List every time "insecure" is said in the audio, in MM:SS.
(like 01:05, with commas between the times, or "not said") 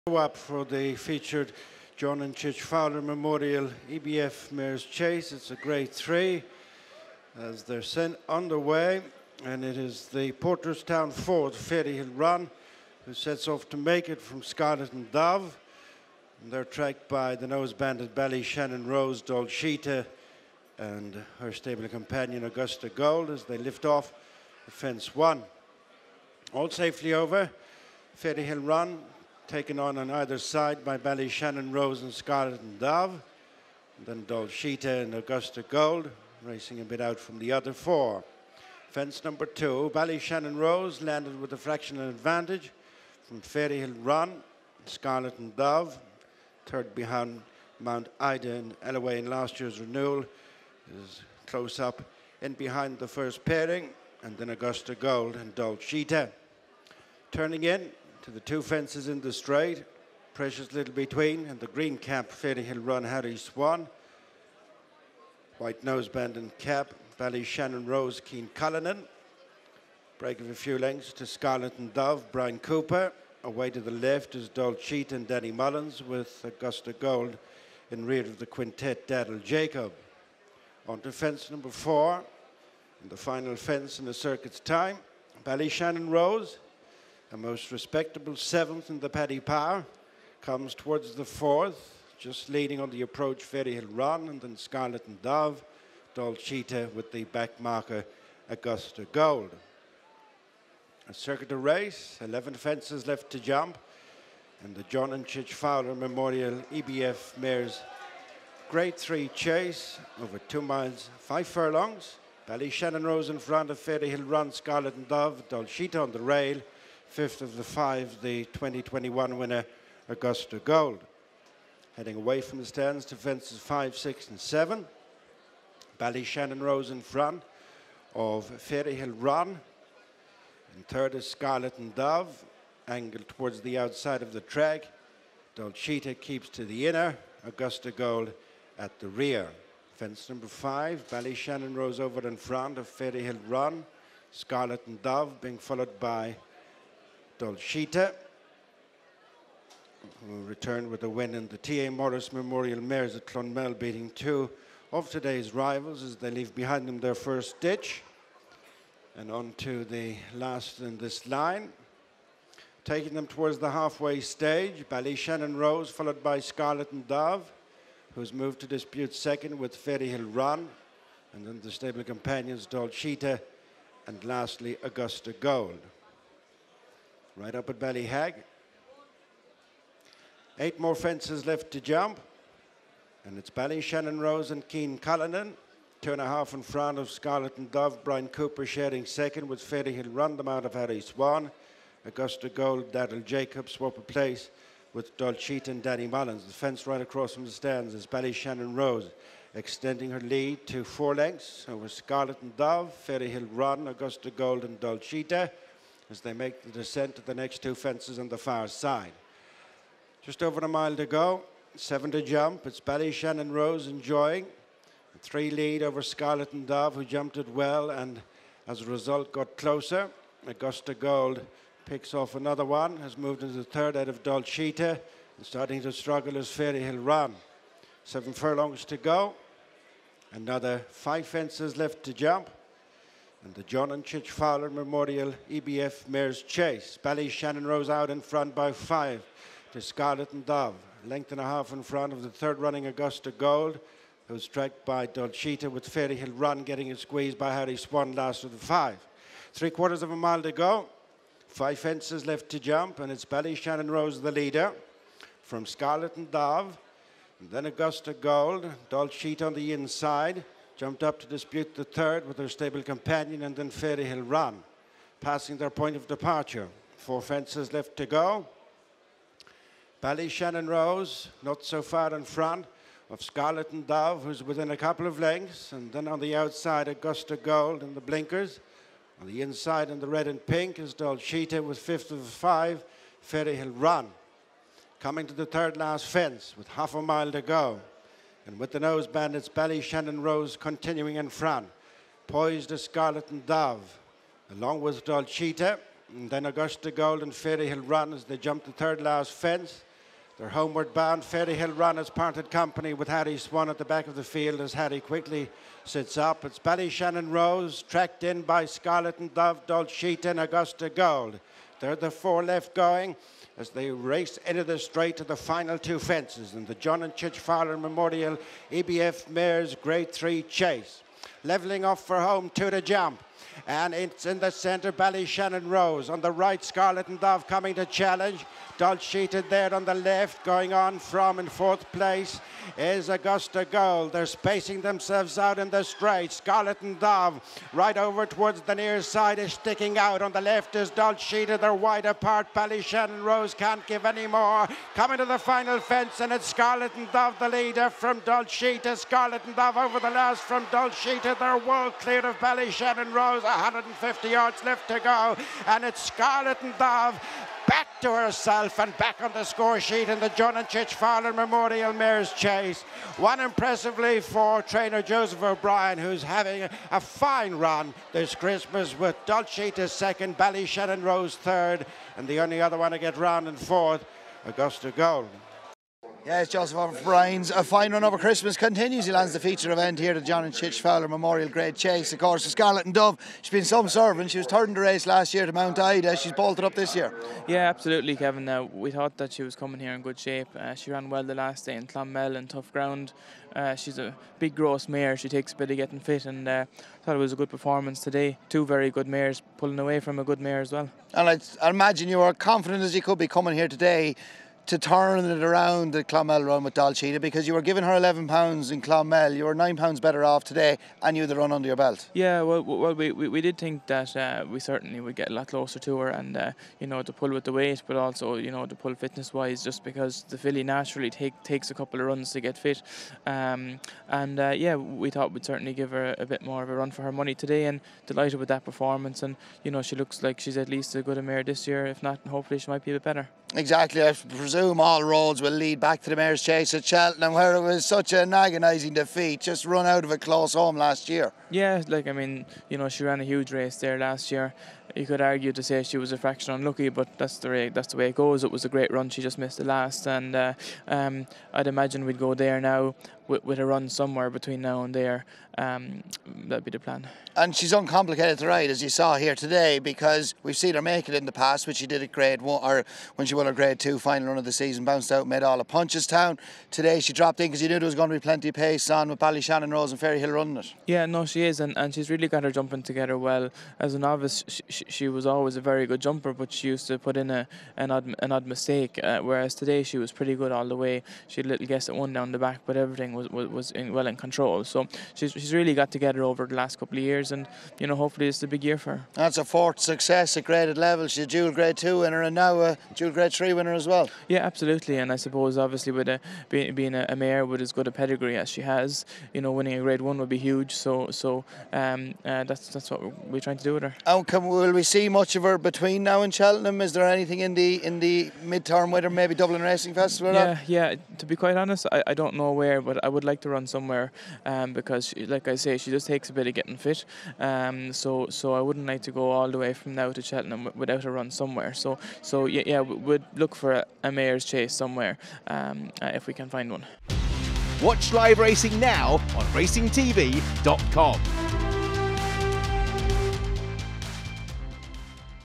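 not said.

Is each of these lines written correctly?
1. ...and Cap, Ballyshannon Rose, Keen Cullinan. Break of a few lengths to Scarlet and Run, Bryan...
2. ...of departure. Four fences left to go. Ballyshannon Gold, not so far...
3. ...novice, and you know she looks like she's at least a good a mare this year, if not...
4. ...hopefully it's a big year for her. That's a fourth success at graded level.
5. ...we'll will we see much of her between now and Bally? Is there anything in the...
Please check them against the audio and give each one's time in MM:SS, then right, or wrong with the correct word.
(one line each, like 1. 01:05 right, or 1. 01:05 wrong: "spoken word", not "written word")
1. 01:06 wrong: "Dove", not "Run"
2. 04:25 wrong: "Rose", not "Gold"
3. 07:08 wrong: "performance", not "novice"
4. 08:07 right
5. 08:24 wrong: "Cheltenham", not "Bally".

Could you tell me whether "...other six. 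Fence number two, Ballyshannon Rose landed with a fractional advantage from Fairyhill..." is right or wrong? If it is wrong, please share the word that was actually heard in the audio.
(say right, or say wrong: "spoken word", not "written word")
wrong: "four", not "six".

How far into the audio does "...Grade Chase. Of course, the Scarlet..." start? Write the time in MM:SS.
06:21.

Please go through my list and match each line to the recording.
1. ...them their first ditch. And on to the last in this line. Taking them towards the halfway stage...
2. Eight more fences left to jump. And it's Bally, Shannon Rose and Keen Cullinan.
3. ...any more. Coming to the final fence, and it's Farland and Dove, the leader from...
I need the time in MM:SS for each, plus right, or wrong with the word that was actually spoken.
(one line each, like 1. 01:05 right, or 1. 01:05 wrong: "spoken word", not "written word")
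1. 02:36 right
2. 03:00 right
3. 05:44 wrong: "Scarlet", not "Farland".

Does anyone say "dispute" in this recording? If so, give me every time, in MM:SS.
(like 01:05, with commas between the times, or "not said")
02:48, 04:21.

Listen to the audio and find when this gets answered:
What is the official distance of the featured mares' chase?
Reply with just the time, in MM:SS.
01:50.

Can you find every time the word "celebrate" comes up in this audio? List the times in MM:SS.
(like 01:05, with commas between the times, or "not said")
not said.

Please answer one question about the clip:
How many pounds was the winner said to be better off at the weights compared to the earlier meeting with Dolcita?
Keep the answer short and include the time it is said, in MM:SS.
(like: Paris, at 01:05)
9, at 06:49.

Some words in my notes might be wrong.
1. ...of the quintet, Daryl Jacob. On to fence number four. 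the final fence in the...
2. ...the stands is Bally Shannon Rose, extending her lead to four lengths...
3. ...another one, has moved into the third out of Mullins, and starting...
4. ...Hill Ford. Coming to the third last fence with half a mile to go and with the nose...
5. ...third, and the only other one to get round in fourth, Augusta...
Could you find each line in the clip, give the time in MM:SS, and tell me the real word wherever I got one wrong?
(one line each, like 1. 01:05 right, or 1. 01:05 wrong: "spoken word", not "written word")
1. 01:18 right
2. 03:17 right
3. 03:42 wrong: "Dolcita", not "Mullins"
4. 04:43 wrong: "Run", not "Ford"
5. 06:11 right.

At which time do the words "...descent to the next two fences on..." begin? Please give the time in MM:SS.
03:26.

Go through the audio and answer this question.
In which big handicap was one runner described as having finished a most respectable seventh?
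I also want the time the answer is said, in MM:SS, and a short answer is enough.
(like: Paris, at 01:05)
Paddy Power, at 01:29.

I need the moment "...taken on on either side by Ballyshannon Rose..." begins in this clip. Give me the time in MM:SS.
00:29.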